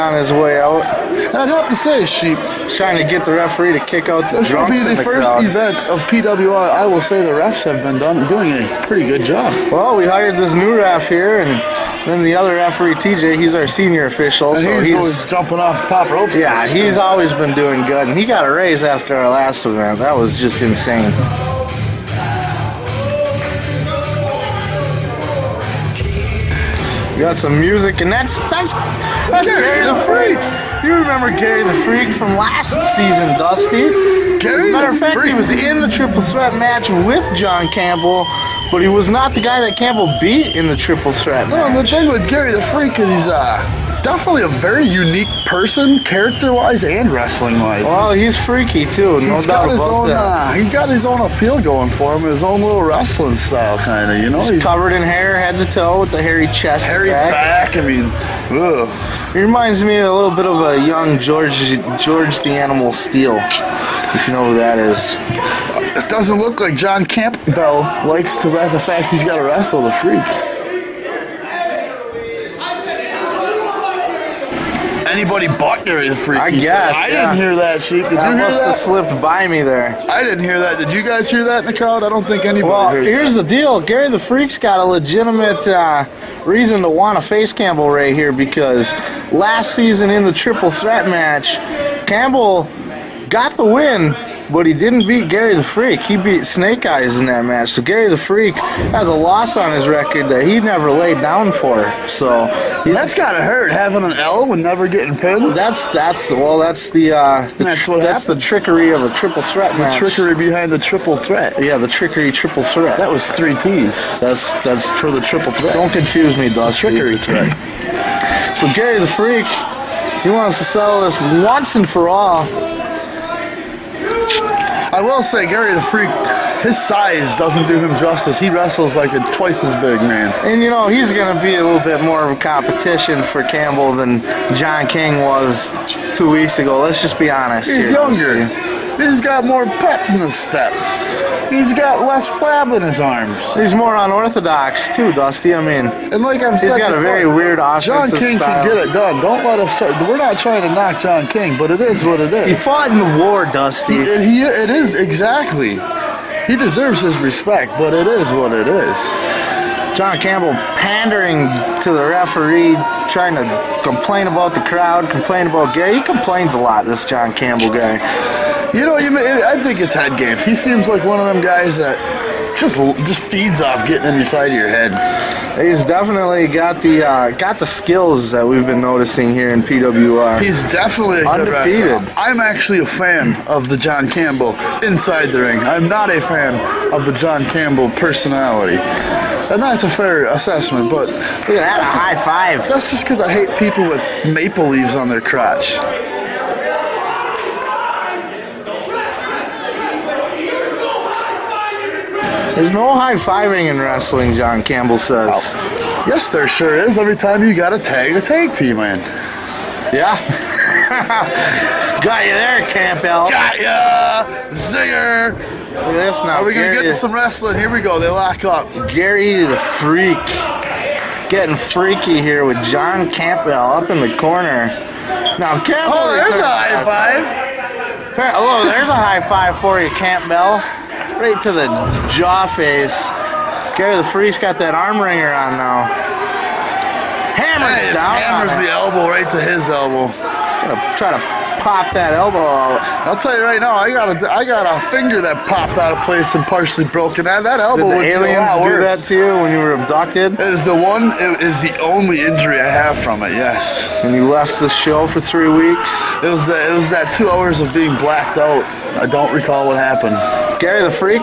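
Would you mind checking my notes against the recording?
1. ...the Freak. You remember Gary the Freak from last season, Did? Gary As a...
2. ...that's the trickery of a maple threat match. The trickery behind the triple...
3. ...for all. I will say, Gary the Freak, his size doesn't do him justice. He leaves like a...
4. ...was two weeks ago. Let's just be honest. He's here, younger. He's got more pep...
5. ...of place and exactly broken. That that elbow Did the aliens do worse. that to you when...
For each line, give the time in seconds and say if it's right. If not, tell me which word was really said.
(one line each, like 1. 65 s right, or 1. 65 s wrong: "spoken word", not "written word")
1. 29 s wrong: "Dusty", not "Did"
2. 107 s wrong: "triple", not "maple"
3. 121 s wrong: "wrestles", not "leaves"
4. 135 s right
5. 245 s wrong: "partially", not "exactly".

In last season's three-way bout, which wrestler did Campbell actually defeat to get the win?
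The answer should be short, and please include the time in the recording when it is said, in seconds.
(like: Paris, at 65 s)
Snake Eyes, at 96 s.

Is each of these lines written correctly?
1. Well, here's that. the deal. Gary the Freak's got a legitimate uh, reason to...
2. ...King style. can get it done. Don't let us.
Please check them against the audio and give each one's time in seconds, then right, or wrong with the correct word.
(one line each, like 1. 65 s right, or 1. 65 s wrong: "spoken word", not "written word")
1. 82 s right
2. 148 s right.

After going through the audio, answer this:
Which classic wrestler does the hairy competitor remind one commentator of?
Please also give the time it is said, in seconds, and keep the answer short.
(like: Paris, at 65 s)
George the Animal Steele, at 61 s.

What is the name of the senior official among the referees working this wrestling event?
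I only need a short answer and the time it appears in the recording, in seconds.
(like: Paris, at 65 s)
TJ, at 12 s.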